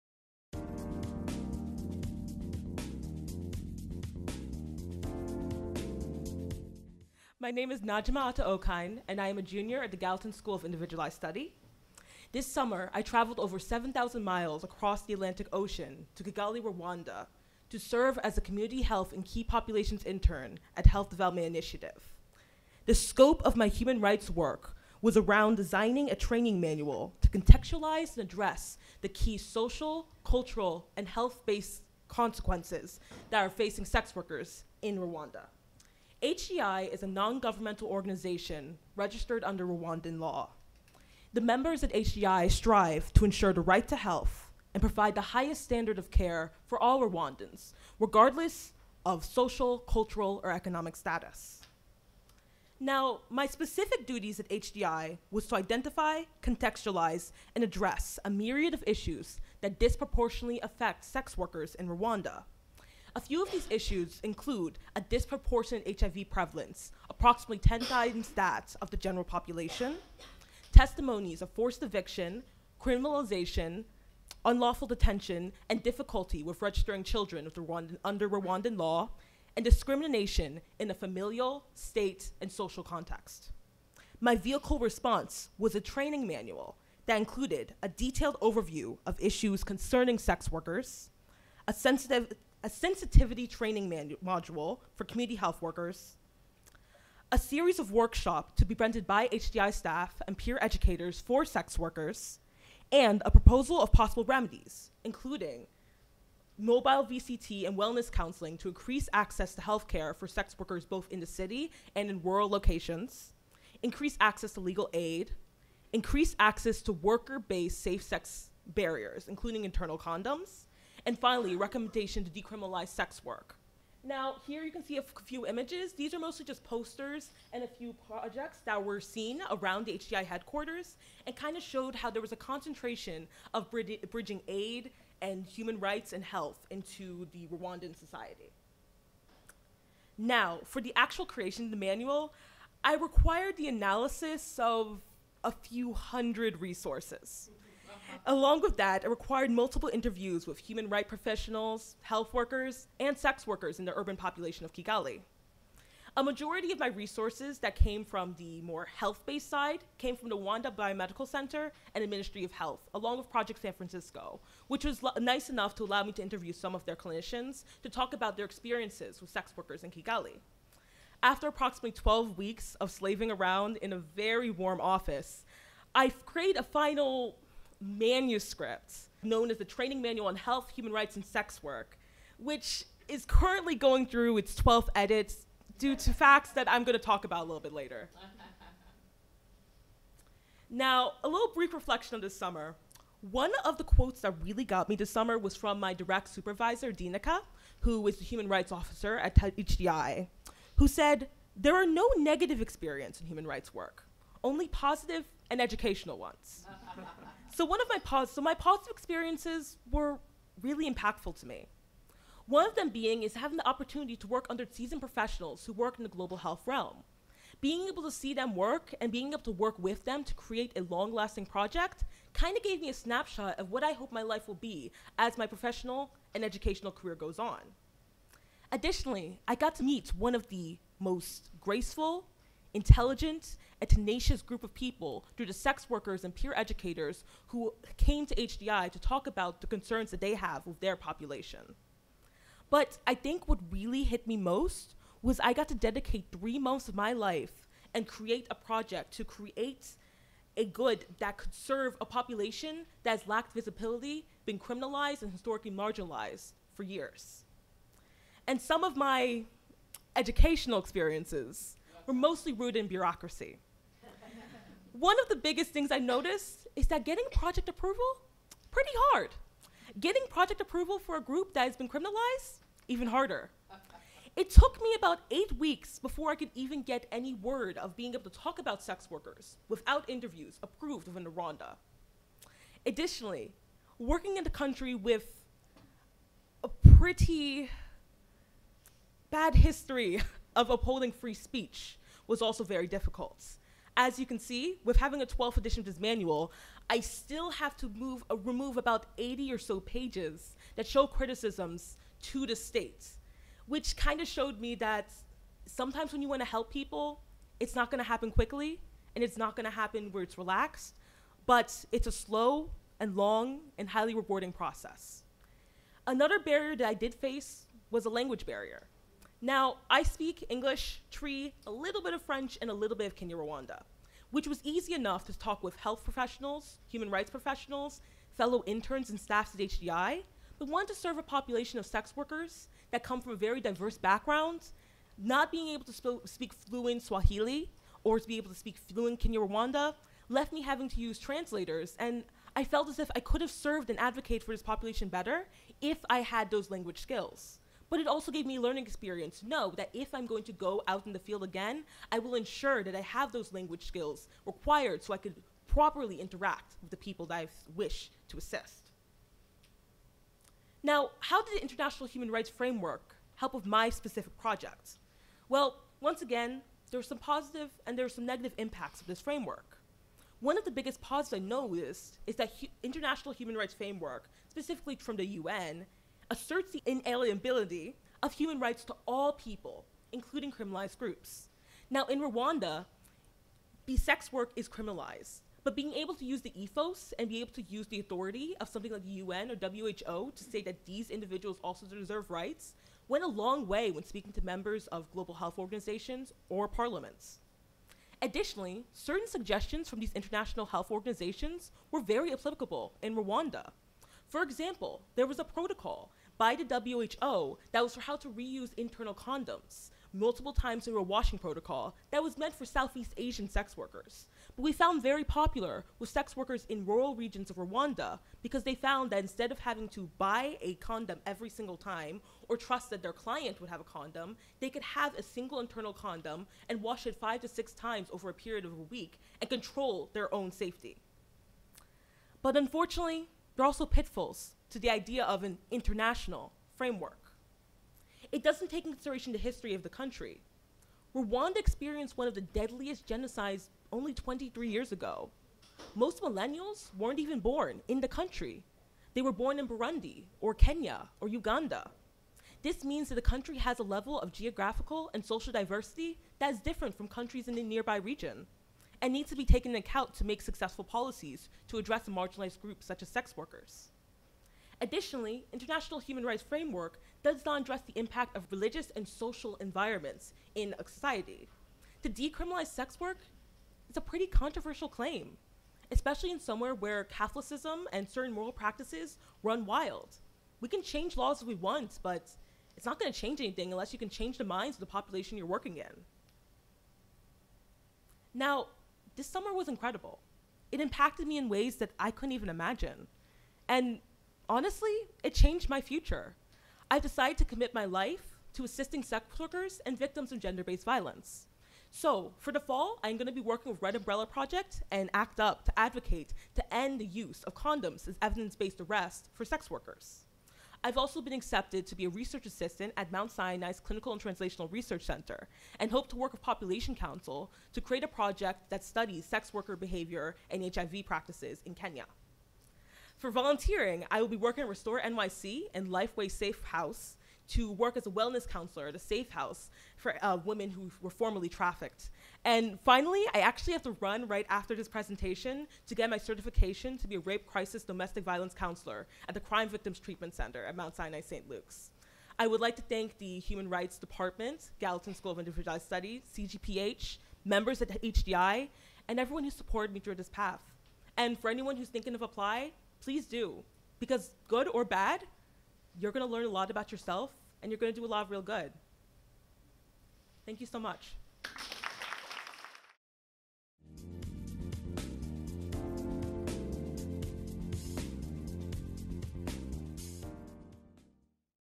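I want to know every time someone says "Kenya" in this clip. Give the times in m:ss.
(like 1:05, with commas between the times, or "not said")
7:30, 8:41.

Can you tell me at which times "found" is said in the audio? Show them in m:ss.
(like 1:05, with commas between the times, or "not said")
6:54, 6:58.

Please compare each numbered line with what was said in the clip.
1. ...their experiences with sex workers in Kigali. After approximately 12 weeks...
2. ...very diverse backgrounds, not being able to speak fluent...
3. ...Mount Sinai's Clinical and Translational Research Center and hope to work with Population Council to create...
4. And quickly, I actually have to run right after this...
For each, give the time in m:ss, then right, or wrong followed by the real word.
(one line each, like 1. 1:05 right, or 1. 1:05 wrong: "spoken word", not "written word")
1. 2:48 right
2. 5:33 right
3. 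8:33 right
4. 8:52 wrong: "finally", not "quickly".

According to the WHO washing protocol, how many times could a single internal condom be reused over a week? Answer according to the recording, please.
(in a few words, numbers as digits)
5 to 6.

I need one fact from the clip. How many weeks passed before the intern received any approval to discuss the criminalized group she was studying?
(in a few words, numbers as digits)
8.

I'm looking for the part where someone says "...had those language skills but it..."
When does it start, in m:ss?
5:46.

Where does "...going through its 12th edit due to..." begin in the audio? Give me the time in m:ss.
3:03.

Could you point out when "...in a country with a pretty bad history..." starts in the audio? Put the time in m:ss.
4:44.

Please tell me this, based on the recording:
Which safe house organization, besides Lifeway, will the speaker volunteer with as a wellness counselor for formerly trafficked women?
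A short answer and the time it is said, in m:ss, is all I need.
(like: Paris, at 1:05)
Restore NYC, at 8:44.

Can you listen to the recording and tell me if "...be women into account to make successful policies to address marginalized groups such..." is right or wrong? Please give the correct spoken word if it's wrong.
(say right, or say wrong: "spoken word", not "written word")
wrong: "taken", not "women".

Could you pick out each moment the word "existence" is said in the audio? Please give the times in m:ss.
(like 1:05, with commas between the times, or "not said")
not said.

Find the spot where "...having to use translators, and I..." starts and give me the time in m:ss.
5:40.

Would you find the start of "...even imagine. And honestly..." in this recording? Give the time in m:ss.
8:12.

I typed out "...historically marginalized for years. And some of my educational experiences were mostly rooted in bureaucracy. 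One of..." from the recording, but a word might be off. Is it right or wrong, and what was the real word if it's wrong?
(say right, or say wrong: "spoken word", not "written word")
right.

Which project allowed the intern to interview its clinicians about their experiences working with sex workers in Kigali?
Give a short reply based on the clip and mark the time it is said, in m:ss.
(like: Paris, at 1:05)
Project San Francisco, at 2:43.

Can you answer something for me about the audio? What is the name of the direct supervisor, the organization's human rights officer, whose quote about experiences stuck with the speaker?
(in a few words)
Dinika.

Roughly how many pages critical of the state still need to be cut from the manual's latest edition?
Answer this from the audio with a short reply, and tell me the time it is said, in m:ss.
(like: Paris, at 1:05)
80, at 4:58.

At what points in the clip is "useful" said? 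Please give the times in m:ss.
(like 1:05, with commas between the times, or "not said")
not said.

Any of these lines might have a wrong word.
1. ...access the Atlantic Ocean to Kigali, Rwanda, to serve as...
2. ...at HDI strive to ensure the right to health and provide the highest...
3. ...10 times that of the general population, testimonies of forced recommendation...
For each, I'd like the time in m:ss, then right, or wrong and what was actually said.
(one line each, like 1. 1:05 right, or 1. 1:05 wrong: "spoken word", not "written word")
1. 0:14 wrong: "across", not "access"
2. 0:41 right
3. 1:07 wrong: "eviction", not "recommendation".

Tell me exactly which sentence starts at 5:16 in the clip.
Another barrier that I did face was a language barrier.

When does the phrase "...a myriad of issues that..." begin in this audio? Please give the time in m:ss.
0:58.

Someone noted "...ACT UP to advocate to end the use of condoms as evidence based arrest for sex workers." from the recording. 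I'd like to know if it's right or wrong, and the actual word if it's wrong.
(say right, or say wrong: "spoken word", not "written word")
right.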